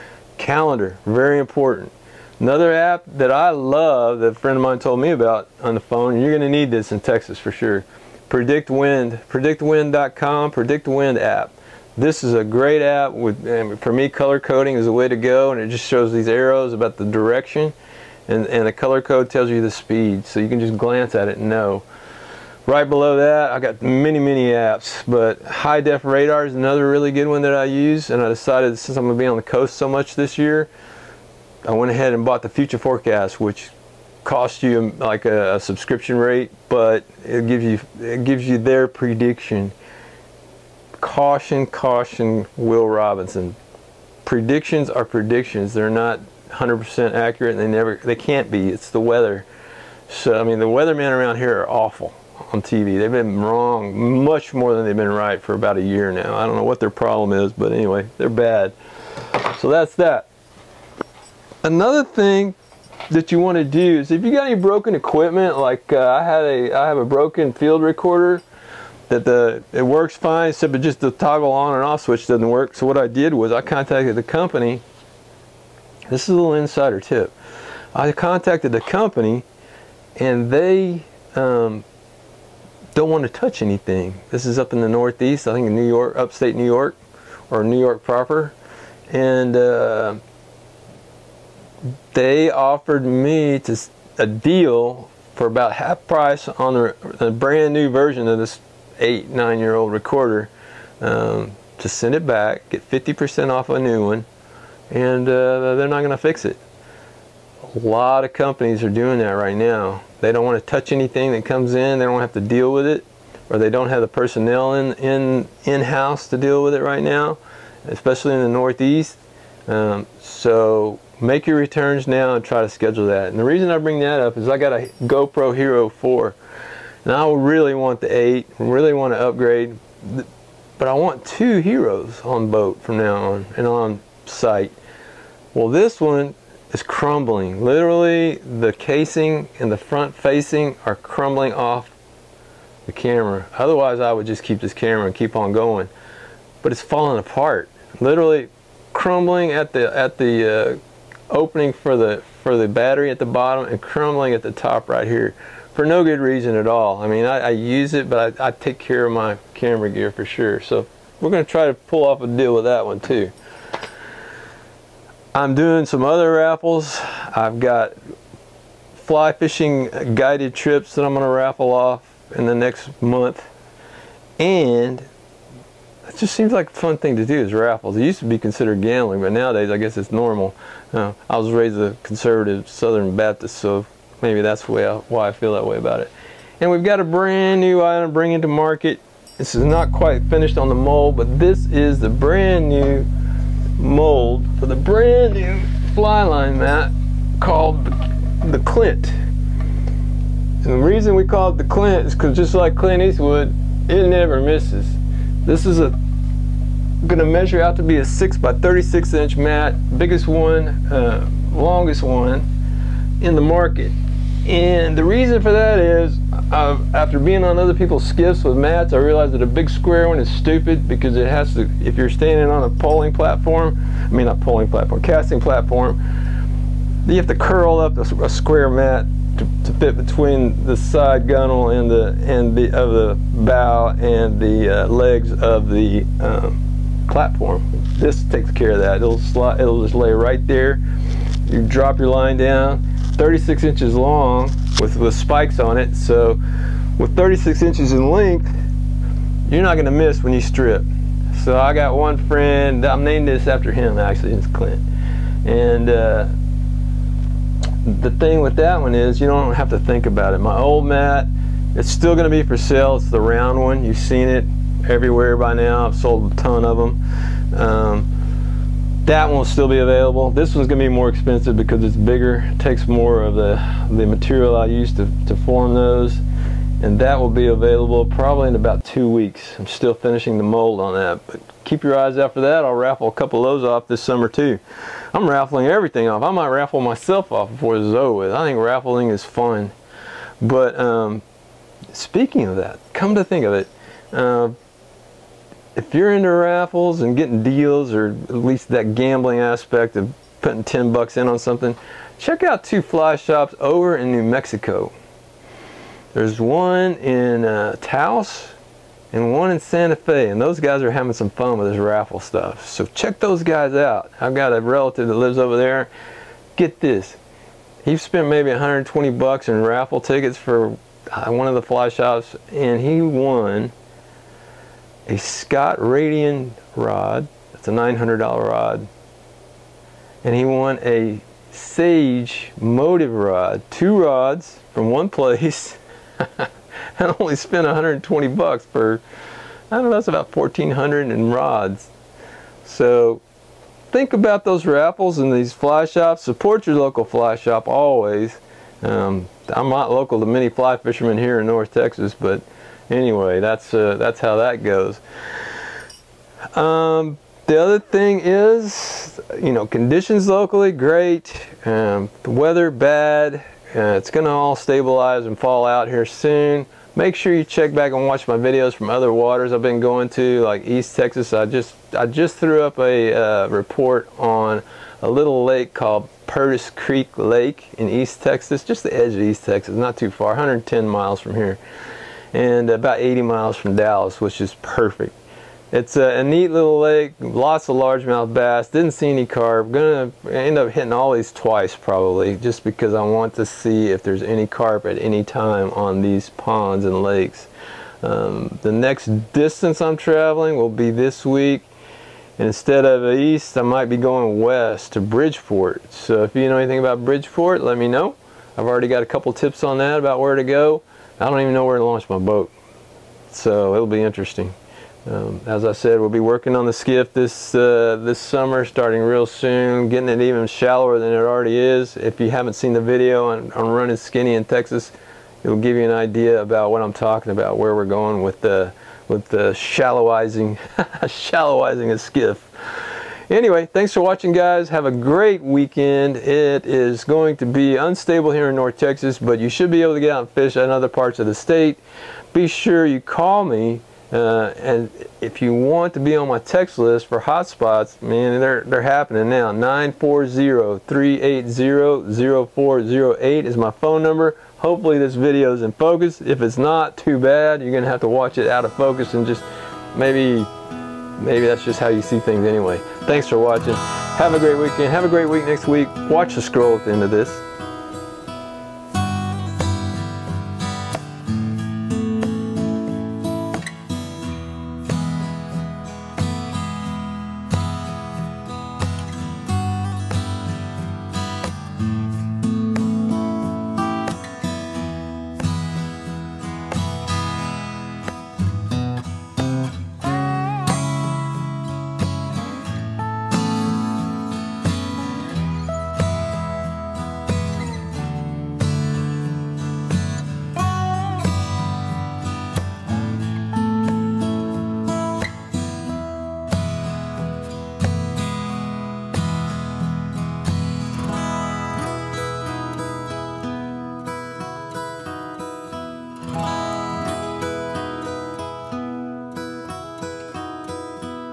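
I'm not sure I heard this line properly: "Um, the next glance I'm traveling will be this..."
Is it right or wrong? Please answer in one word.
wrong.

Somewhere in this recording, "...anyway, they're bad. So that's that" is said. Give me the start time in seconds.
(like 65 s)
57 s.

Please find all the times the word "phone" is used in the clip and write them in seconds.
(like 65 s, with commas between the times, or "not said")
5 s, 453 s.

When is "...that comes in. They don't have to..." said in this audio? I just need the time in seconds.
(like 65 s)
111 s.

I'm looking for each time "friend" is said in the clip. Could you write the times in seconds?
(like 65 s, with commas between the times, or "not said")
4 s, 252 s.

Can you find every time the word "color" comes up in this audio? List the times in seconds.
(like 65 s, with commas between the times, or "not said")
14 s, 18 s.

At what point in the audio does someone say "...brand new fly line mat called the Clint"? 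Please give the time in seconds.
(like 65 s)
194 s.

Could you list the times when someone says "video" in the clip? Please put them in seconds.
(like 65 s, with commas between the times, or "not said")
368 s, 422 s, 455 s.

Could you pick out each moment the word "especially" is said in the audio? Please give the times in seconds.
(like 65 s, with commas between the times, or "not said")
117 s.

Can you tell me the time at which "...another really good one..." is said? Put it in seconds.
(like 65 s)
26 s.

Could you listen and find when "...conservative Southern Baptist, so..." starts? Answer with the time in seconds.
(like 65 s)
182 s.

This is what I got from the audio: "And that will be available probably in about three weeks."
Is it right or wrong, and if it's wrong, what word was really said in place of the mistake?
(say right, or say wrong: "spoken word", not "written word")
wrong: "two", not "three".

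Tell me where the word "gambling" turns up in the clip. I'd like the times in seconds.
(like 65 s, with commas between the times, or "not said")
178 s, 298 s.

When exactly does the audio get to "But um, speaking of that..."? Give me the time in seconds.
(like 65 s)
290 s.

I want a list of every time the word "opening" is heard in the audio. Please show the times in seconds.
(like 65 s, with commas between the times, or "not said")
151 s.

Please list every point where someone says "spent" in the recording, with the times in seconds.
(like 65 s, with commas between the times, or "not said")
317 s, 337 s.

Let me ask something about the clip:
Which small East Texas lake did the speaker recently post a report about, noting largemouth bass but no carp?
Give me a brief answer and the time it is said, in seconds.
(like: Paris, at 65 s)
Purtis Creek Lake, at 376 s.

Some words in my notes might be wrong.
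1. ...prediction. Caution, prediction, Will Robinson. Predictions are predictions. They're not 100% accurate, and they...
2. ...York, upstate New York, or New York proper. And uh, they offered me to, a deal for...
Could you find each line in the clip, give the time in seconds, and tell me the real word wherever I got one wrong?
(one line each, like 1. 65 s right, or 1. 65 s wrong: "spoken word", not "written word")
1. 38 s wrong: "caution", not "prediction"
2. 85 s right.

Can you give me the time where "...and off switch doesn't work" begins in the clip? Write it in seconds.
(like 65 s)
71 s.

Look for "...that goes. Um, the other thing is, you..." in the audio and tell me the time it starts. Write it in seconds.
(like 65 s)
354 s.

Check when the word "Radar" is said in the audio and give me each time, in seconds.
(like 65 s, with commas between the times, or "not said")
26 s.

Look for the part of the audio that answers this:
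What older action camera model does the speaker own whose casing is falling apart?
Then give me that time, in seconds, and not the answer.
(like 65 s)
125 s.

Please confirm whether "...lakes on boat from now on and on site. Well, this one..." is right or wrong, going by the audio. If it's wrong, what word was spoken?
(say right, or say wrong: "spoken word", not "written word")
wrong: "heroes", not "lakes".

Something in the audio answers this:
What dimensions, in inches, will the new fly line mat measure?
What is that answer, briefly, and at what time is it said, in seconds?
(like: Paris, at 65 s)
6 by 36, at 208 s.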